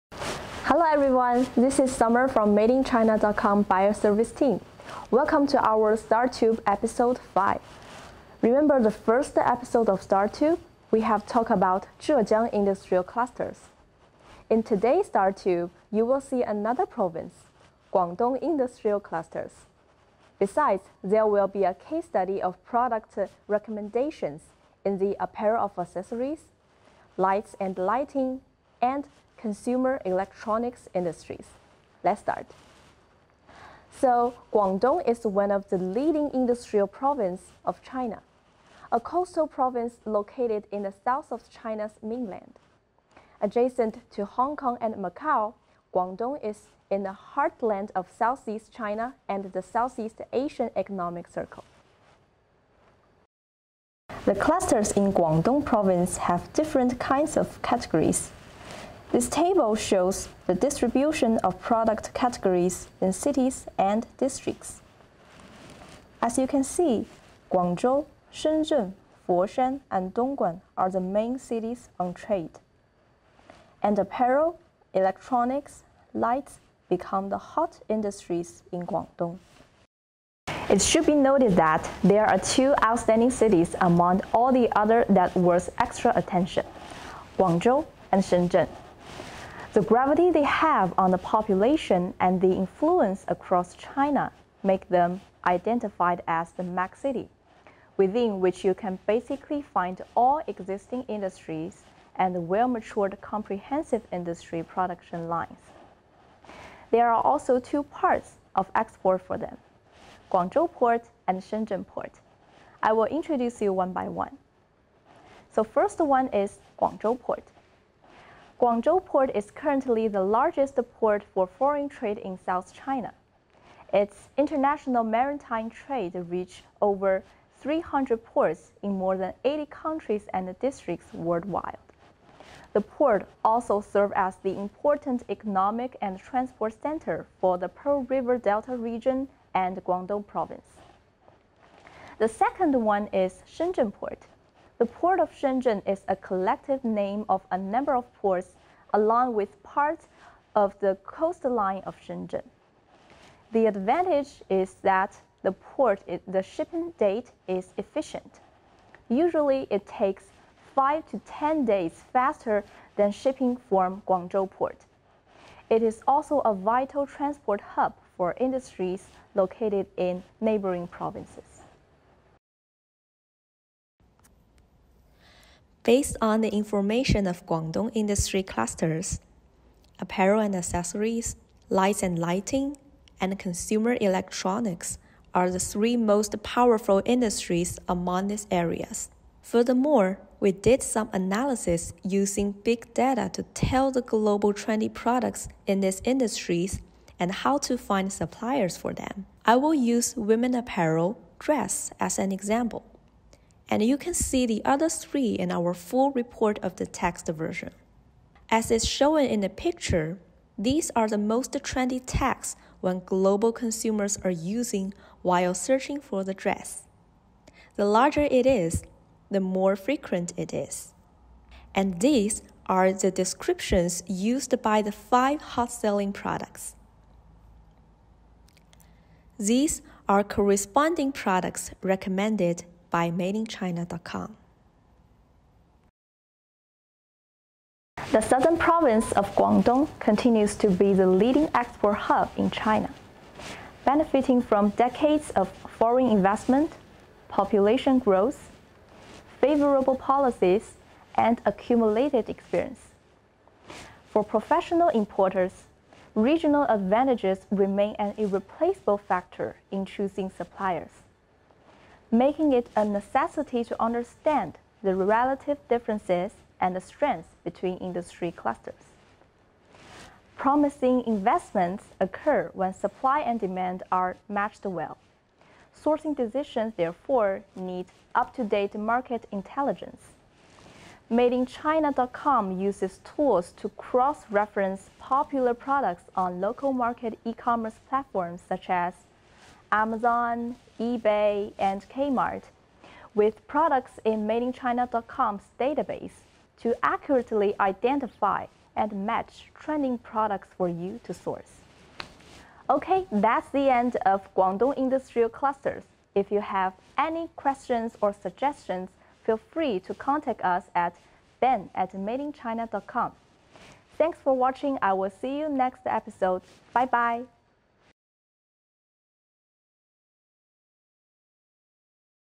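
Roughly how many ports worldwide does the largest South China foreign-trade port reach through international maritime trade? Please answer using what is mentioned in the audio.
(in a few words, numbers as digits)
over 300.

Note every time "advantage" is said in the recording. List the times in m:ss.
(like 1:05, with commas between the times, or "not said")
2:33, 4:16.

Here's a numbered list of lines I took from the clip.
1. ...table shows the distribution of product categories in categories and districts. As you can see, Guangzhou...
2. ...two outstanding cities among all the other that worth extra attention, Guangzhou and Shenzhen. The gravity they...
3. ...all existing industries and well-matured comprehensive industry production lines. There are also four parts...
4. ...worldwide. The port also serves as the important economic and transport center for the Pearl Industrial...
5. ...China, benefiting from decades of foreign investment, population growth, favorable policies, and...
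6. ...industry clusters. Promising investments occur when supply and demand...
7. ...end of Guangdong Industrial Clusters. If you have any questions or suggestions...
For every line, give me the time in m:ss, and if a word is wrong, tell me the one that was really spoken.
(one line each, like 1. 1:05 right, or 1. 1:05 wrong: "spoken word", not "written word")
1. 0:59 wrong: "cities", not "categories"
2. 1:22 right
3. 1:40 wrong: "two", not "four"
4. 2:11 wrong: "River", not "Industrial"
5. 4:02 right
6. 4:27 right
7. 5:03 right.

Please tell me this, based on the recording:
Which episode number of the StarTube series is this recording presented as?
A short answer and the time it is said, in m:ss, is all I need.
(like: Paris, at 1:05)
5, at 0:06.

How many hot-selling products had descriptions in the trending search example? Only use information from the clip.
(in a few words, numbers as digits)
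5.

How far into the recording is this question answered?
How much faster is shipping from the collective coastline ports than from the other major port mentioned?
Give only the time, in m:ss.
2:40.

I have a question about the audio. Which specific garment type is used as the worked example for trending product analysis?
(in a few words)
women apparel dress.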